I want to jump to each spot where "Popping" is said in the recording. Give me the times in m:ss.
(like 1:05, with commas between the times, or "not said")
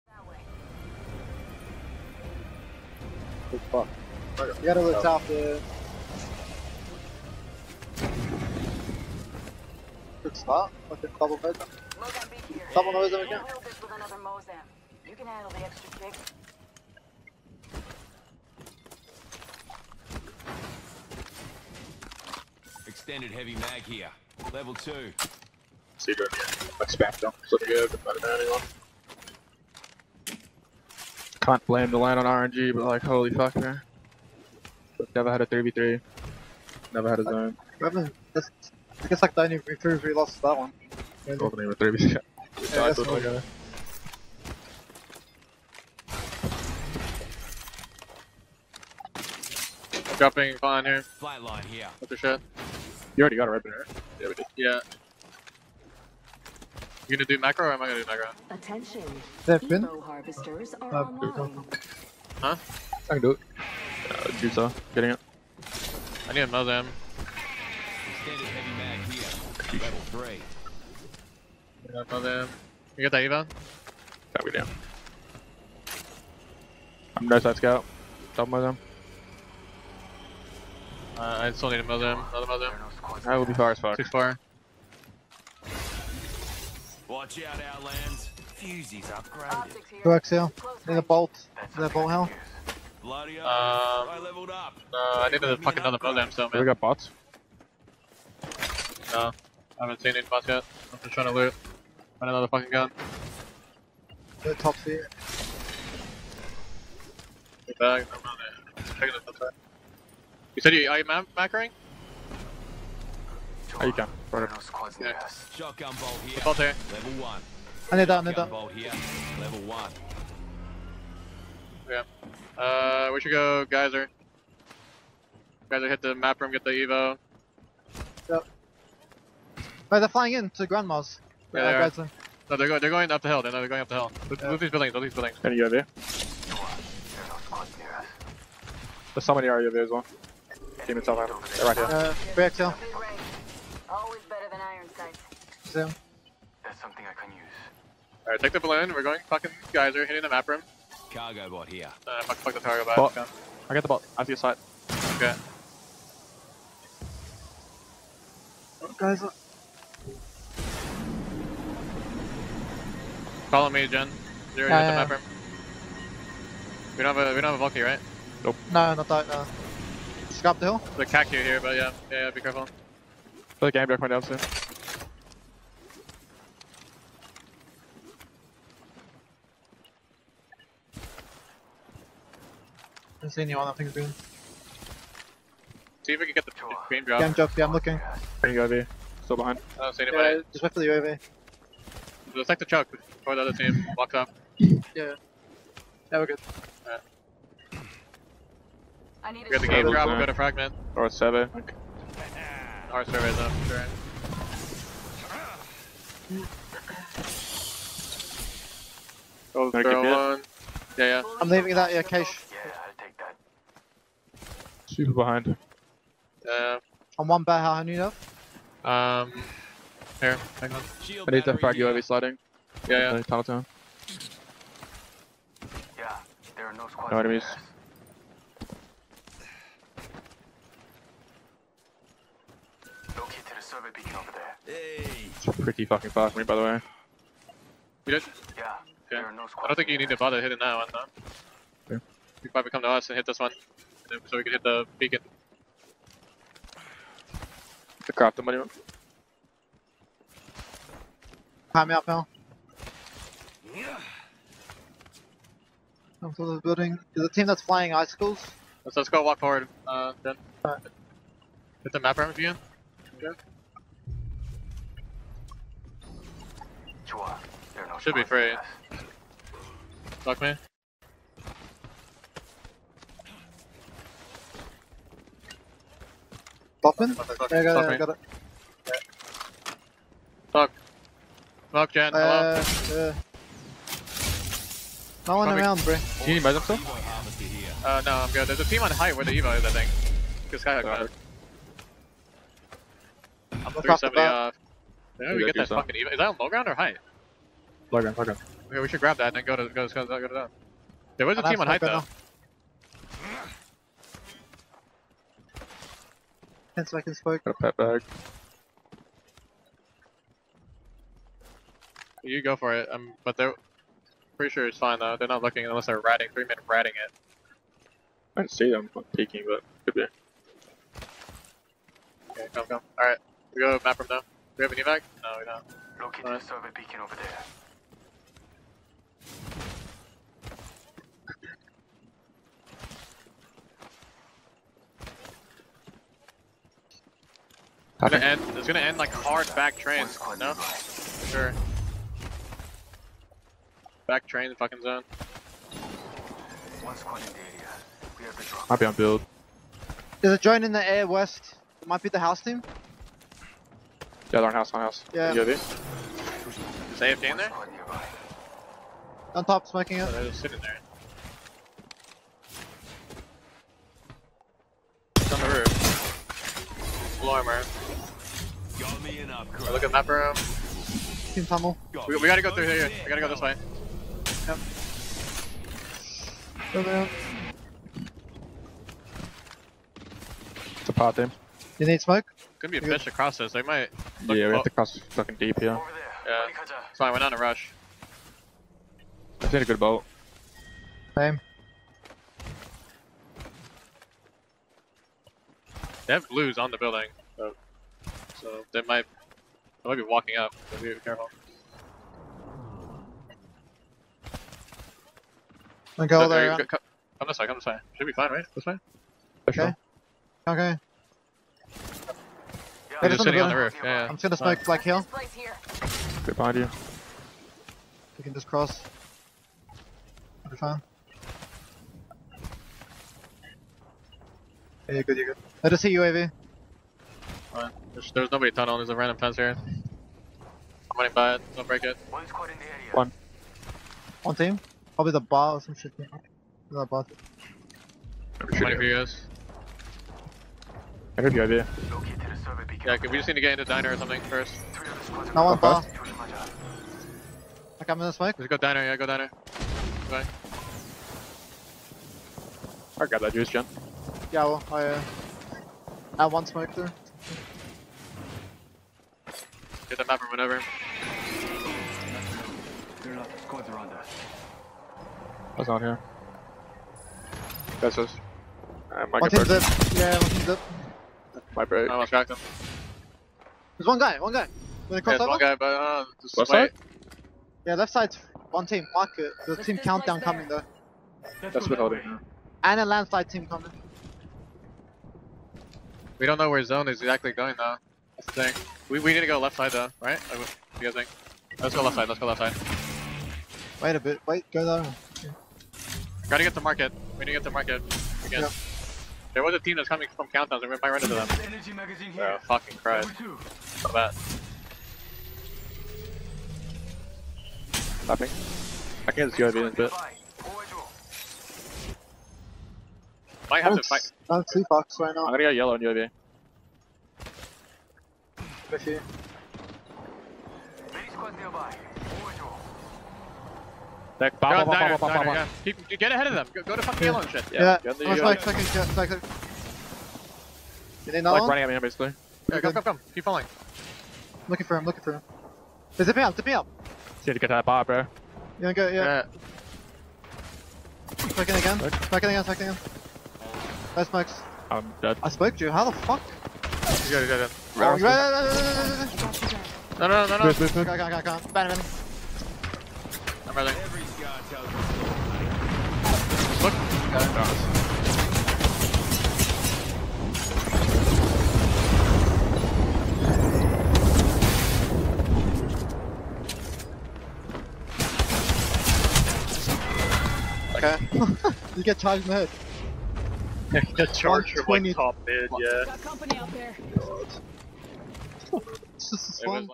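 4:36.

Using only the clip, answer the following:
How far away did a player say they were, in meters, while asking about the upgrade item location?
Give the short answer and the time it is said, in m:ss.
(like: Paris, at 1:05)
370, at 4:53.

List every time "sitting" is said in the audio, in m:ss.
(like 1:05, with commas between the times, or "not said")
6:00, 6:53.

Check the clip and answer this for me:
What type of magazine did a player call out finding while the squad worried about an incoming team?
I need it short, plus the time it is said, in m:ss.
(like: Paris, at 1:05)
Energy magazine, at 8:21.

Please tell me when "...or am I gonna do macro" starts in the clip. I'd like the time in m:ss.
0:57.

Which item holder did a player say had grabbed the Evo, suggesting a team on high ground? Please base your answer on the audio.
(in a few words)
Skyhook.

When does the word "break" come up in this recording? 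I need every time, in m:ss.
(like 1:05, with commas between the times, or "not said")
7:11, 7:51.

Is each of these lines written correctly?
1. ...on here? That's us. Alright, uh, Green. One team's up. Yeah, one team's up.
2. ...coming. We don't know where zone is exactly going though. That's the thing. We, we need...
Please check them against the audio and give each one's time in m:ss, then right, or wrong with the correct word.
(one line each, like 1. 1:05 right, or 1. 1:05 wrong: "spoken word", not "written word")
1. 7:45 wrong: "Mike", not "Green"
2. 8:03 right.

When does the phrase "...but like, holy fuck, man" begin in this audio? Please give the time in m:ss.
0:32.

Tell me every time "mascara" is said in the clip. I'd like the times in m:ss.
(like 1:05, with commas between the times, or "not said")
not said.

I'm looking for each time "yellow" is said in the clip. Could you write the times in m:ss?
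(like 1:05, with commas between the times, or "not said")
8:35, 8:47.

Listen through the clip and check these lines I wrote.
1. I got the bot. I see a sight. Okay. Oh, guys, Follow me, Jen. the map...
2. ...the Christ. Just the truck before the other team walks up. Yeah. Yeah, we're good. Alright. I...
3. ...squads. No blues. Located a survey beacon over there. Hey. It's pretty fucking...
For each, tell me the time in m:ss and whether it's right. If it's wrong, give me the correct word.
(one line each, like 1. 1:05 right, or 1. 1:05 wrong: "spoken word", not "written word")
1. 2:33 right
2. 3:10 wrong: "UAV", not "Christ"
3. 3:46 wrong: "enemies", not "blues".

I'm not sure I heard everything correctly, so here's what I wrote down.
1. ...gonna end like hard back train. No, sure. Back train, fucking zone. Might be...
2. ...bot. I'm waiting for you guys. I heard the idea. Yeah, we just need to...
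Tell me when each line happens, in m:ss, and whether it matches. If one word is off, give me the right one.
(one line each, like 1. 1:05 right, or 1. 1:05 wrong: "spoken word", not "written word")
1. 5:38 right
2. 7:16 right.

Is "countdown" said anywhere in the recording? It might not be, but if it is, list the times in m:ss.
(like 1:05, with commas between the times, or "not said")
7:59, 8:20.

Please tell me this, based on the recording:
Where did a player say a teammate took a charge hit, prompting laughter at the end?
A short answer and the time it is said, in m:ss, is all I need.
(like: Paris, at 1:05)
in the head, at 9:32.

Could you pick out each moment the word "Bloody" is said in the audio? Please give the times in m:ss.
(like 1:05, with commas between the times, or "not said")
1:33.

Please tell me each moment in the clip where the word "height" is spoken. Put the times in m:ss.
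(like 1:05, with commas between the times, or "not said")
4:48, 4:56, 5:01.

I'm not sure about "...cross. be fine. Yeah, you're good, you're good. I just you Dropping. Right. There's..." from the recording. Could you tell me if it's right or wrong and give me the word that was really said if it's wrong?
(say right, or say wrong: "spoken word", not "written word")
wrong: "UAV", not "Dropping".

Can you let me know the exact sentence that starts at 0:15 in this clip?
You can handle the extra kick.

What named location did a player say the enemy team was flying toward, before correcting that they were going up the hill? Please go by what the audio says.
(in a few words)
Grandma's.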